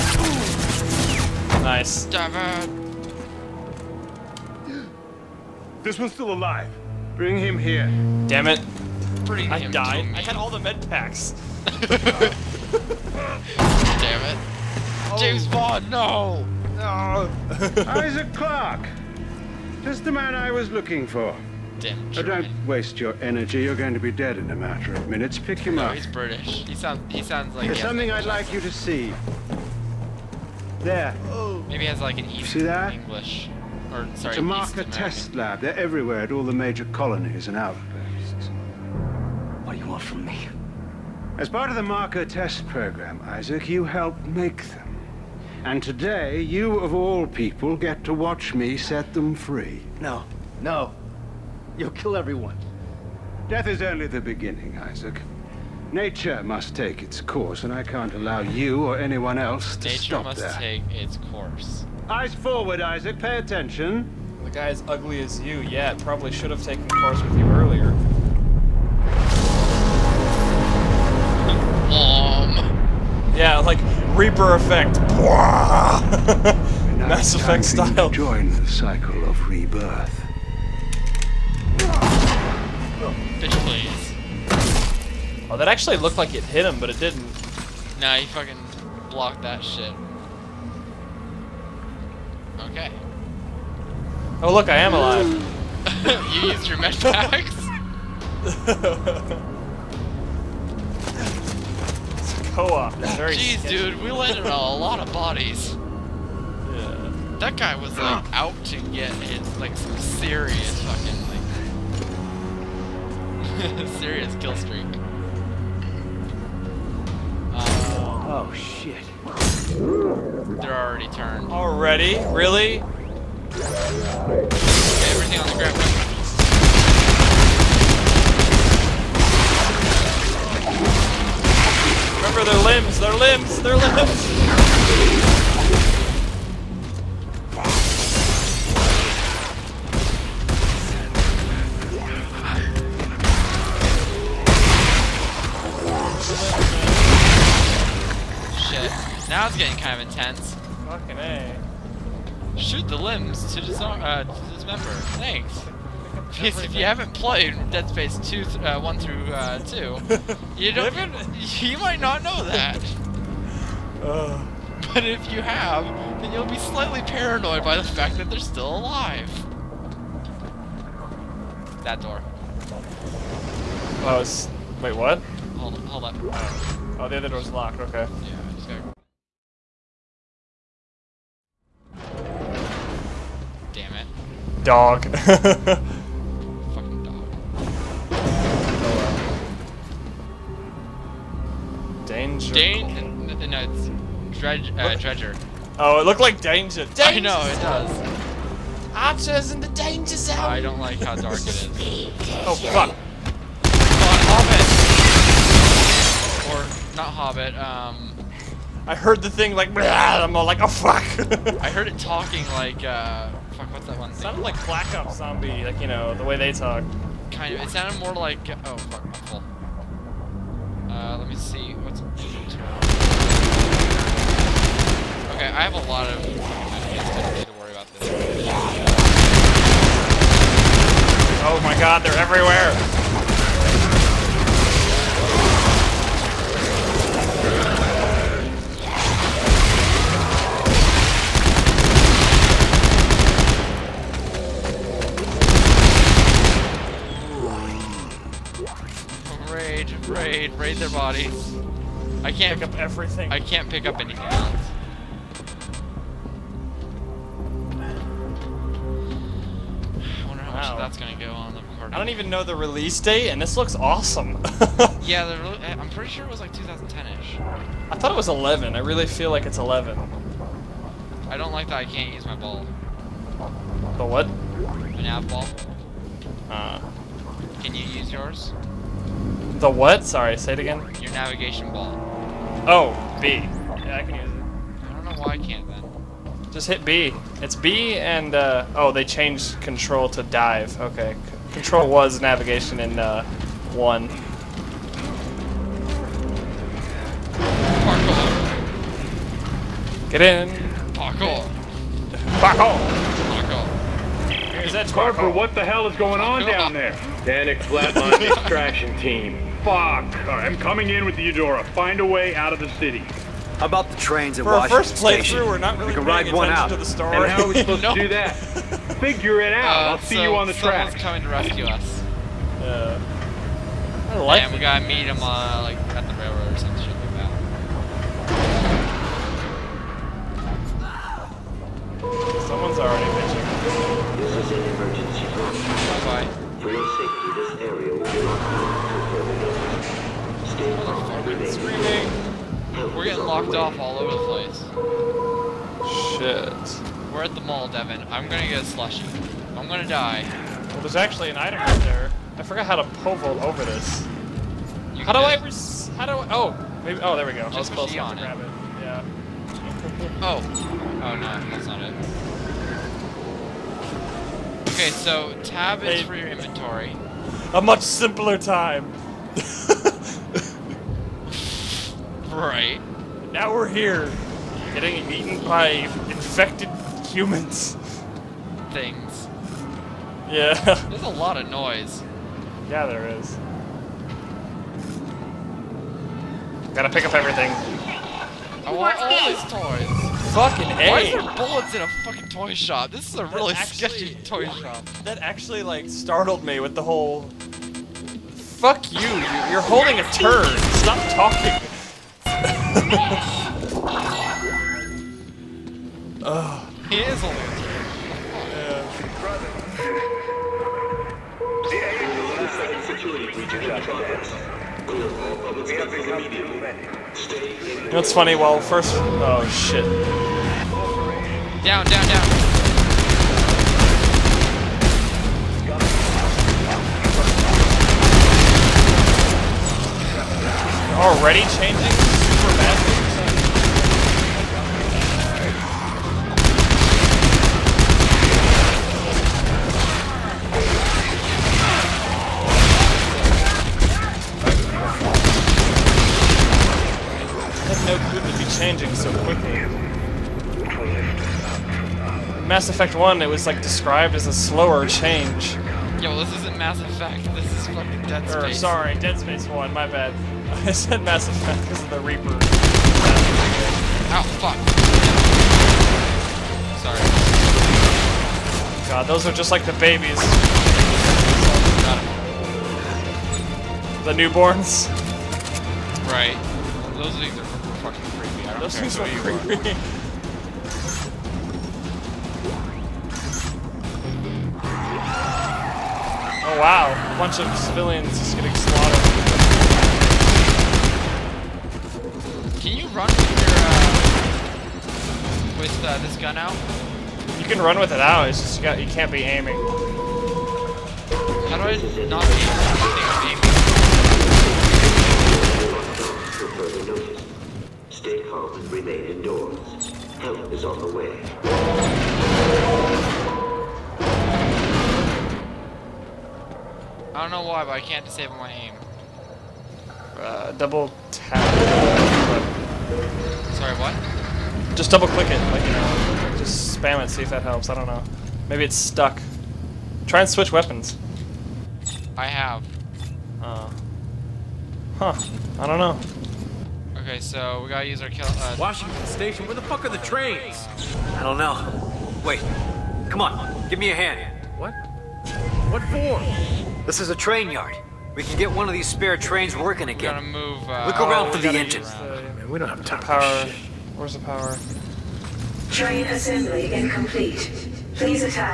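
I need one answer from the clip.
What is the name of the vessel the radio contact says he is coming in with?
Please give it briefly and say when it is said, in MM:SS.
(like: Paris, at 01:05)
Eudora, at 05:11.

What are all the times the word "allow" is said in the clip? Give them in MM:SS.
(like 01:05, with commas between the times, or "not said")
00:58.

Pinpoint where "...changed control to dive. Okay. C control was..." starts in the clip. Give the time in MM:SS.
04:49.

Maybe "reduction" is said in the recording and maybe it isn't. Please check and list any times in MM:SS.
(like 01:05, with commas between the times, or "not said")
not said.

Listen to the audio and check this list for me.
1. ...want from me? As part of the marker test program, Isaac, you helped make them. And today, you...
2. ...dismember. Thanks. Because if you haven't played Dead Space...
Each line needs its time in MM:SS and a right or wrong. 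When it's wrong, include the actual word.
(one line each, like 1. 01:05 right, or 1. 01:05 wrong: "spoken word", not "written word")
1. 00:39 right
2. 02:34 right.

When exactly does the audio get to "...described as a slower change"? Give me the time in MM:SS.
07:33.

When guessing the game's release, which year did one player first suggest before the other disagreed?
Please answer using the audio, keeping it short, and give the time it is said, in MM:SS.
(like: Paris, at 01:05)
2010, at 04:26.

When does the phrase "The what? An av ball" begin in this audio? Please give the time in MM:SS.
04:33.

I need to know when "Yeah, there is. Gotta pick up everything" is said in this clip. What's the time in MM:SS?
06:22.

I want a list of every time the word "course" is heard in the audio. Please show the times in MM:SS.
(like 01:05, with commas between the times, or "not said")
00:57, 01:01, 01:06.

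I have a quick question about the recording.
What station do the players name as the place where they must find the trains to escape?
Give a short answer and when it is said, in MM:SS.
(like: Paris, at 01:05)
Washington Station, at 08:58.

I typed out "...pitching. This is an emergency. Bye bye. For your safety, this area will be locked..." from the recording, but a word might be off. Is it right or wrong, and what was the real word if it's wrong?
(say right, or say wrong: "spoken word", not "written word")
right.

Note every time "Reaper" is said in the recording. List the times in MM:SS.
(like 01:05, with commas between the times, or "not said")
01:14, 07:42.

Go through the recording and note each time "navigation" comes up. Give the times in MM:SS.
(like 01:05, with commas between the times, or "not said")
04:41, 04:52.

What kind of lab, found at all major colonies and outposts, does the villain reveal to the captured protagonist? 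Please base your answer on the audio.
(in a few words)
Marker test lab.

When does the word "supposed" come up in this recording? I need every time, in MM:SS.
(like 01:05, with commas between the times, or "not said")
05:17.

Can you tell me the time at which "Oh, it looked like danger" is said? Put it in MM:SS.
03:15.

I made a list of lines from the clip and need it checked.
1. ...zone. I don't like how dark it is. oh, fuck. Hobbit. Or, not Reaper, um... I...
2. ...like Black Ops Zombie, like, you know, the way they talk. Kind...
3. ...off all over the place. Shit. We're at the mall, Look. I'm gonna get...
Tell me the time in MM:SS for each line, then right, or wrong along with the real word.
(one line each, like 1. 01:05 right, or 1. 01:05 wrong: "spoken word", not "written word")
1. 03:20 wrong: "Hobbit", not "Reaper"
2. 03:34 right
3. 05:43 wrong: "Devin", not "Look".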